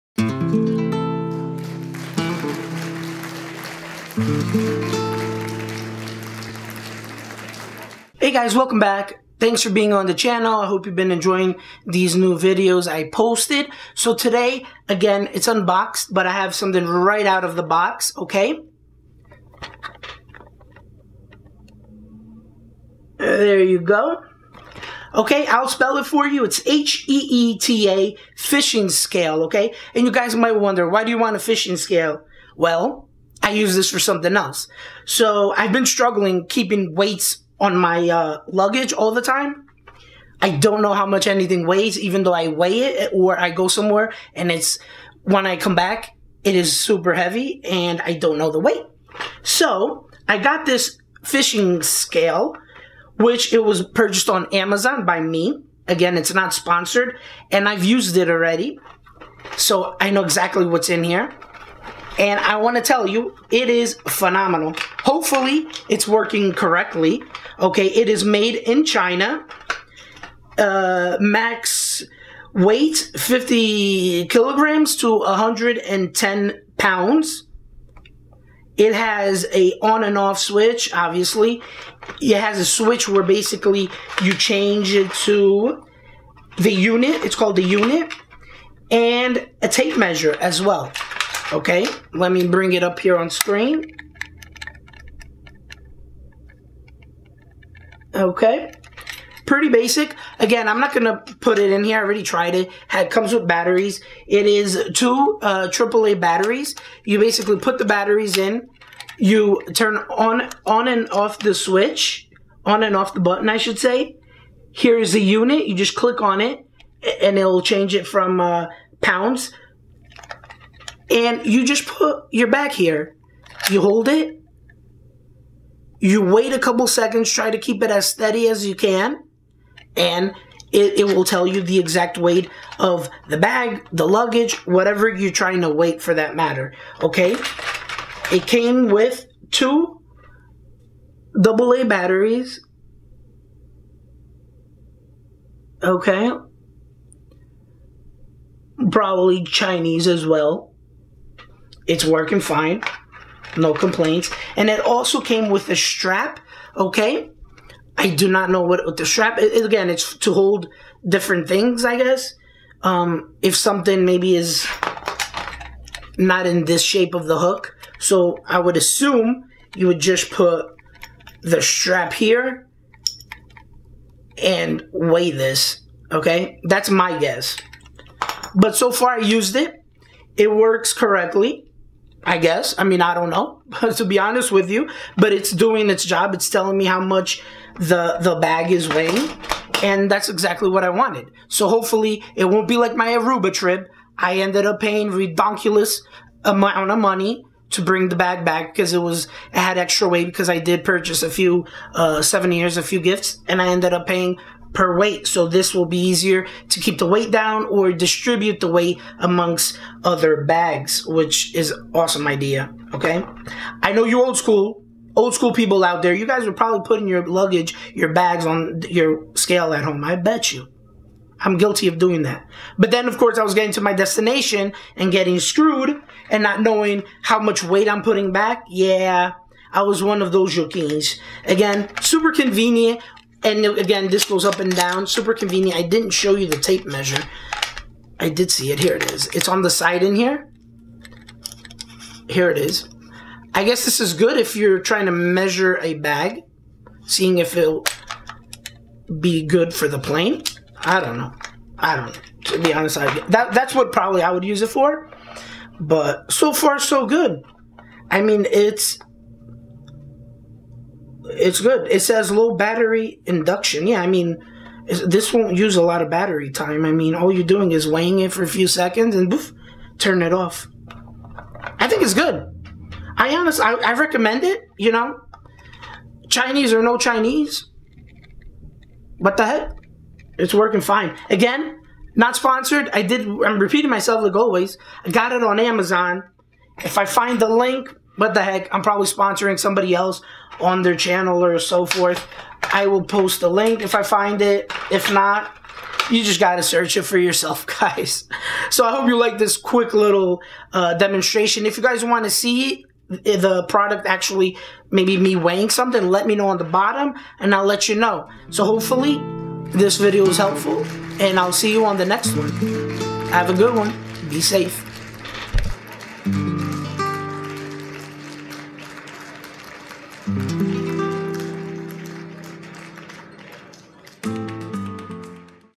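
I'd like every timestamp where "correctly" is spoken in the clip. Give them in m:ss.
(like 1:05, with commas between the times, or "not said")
1:06, 3:00.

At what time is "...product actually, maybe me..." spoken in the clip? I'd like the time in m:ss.
5:03.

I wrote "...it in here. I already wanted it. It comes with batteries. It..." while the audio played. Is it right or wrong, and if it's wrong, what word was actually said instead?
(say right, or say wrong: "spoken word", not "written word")
wrong: "tried", not "wanted".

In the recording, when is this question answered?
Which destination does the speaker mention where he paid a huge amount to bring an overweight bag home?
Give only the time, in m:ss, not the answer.
3:13.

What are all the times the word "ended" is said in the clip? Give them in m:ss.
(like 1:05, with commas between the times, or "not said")
3:14, 3:23.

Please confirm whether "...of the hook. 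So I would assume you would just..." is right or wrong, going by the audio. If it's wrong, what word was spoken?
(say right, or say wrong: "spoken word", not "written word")
right.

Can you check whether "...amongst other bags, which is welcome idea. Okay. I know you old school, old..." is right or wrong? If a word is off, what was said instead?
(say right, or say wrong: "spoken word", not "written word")
wrong: "awesome", not "welcome".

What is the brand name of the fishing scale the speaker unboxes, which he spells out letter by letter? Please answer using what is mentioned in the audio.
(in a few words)
HEETA.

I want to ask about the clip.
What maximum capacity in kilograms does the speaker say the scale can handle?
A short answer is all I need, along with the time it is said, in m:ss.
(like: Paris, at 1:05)
50 kilograms, at 1:13.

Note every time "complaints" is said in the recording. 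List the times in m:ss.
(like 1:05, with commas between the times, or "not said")
2:33.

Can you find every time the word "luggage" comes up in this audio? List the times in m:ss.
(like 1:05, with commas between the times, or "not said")
0:38, 2:14, 3:37.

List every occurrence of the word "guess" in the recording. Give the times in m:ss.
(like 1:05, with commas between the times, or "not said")
2:41, 2:57, 3:02, 4:03.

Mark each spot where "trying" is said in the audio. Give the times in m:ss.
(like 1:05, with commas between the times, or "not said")
2:15, 4:04.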